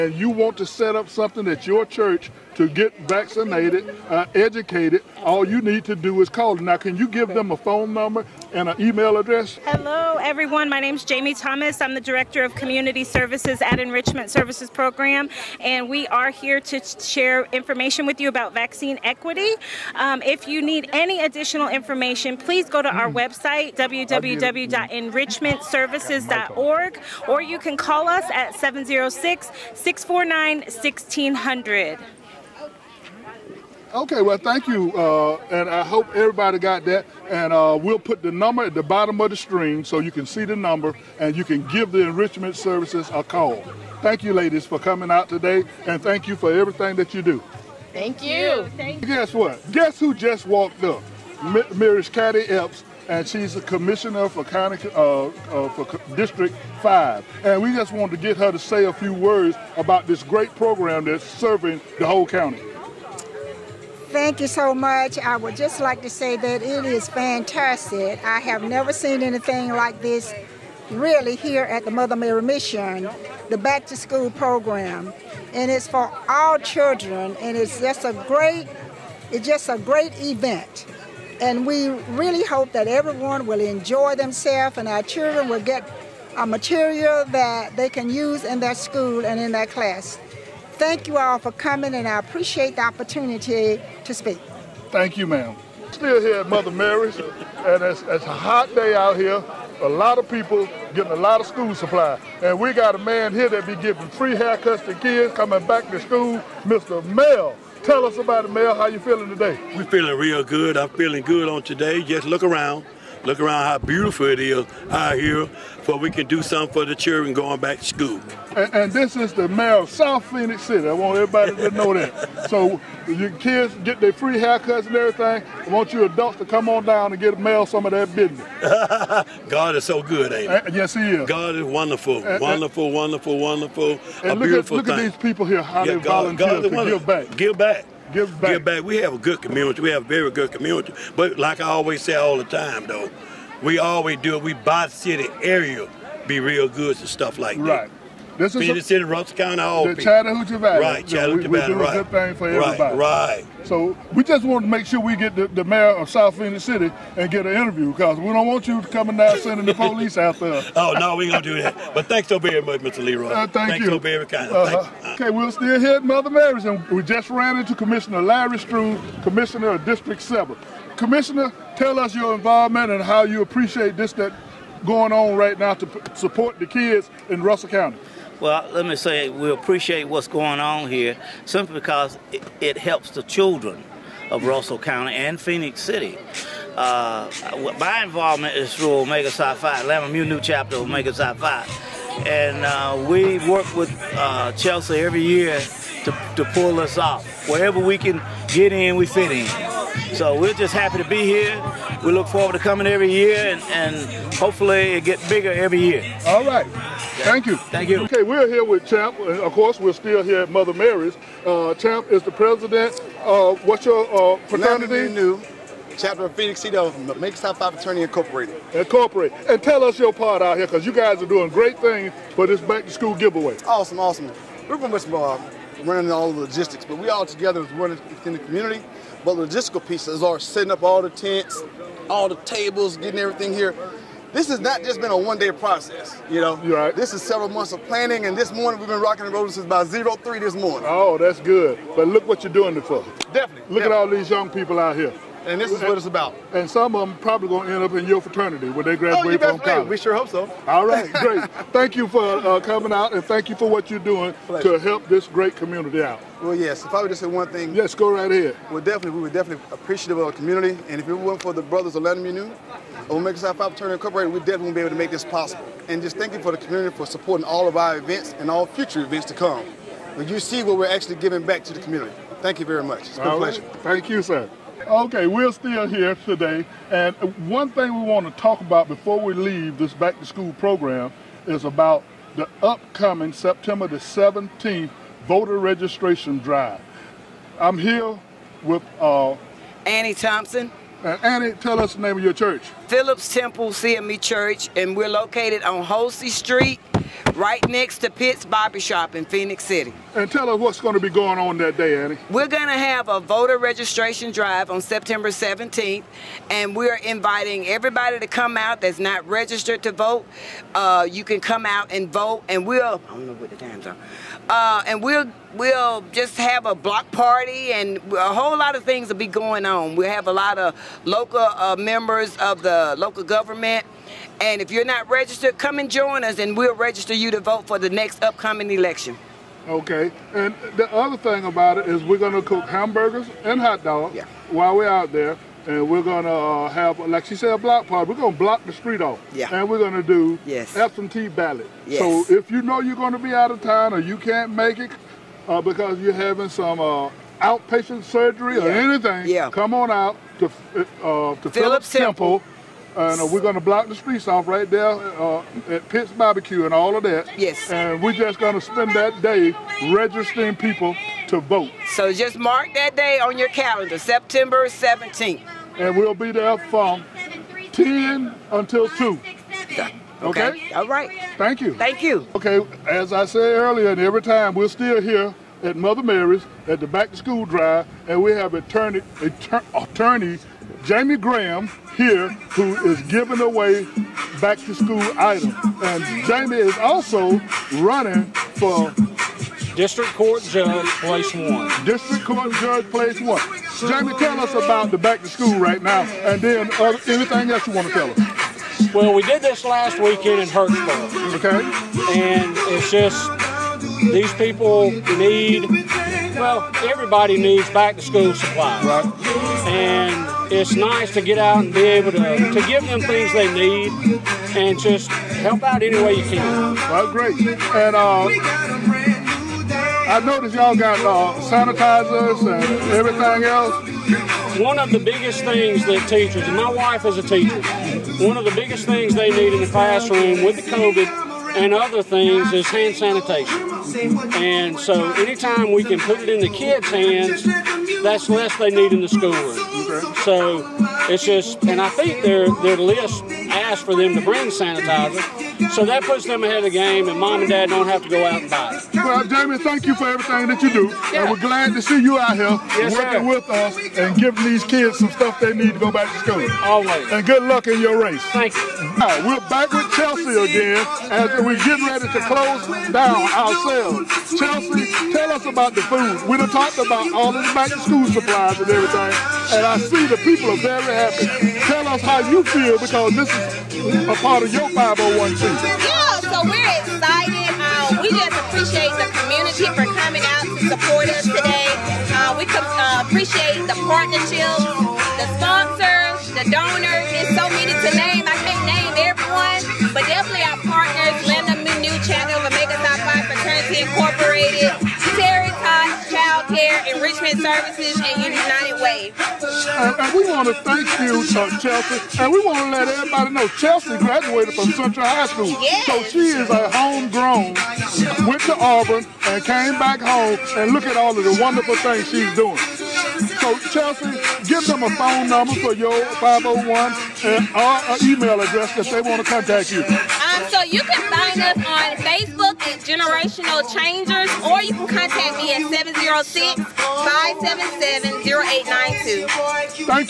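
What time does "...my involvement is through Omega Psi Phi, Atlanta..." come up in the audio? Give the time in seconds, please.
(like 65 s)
187 s.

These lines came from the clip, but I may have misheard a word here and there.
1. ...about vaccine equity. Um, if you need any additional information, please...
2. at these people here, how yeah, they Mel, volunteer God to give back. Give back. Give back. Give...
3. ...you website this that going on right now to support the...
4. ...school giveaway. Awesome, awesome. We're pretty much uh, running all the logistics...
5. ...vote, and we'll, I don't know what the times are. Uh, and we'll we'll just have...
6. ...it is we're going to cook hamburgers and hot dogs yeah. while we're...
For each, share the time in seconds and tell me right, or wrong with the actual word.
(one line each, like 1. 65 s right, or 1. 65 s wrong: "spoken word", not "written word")
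1. 18 s right
2. 135 s wrong: "God", not "Mel"
3. 173 s wrong: "appreciate", not "website"
4. 222 s right
5. 312 s right
6. 331 s right.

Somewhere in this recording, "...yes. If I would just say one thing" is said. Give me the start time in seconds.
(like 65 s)
256 s.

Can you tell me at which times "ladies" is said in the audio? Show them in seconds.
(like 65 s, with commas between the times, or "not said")
44 s.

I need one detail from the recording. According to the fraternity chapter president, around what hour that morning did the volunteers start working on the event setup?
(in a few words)
3 a.m.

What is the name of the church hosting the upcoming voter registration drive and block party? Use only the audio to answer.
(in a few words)
Phillips Temple CME Church.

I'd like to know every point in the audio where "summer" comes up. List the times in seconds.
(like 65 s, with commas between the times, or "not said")
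not said.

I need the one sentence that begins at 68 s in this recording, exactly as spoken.
I have never seen anything like this really here at the Mother Mary Mission, the back to school program.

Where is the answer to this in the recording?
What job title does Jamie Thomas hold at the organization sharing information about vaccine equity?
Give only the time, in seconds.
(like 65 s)
12 s.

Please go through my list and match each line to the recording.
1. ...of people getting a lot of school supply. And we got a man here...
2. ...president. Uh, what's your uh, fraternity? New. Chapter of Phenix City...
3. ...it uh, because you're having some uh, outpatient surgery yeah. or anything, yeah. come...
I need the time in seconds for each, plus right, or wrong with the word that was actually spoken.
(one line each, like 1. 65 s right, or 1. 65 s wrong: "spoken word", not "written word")
1. 100 s right
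2. 212 s right
3. 344 s right.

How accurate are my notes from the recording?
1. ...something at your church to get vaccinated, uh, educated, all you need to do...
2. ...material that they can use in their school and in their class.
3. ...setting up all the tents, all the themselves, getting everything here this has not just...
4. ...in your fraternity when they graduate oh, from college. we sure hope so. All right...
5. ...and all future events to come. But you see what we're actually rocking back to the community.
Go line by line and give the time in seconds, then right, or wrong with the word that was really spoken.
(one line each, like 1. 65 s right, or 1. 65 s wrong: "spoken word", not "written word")
1. 1 s right
2. 86 s right
3. 230 s wrong: "tables", not "themselves"
4. 247 s right
5. 268 s wrong: "giving", not "rocking".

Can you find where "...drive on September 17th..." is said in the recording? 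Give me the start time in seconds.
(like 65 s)
304 s.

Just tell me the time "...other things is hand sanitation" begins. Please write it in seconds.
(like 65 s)
431 s.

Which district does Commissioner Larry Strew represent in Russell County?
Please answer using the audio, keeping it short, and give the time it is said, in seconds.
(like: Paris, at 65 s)
District Seven, at 169 s.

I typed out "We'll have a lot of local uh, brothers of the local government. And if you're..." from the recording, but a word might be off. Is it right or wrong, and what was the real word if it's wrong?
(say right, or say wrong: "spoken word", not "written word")
wrong: "members", not "brothers".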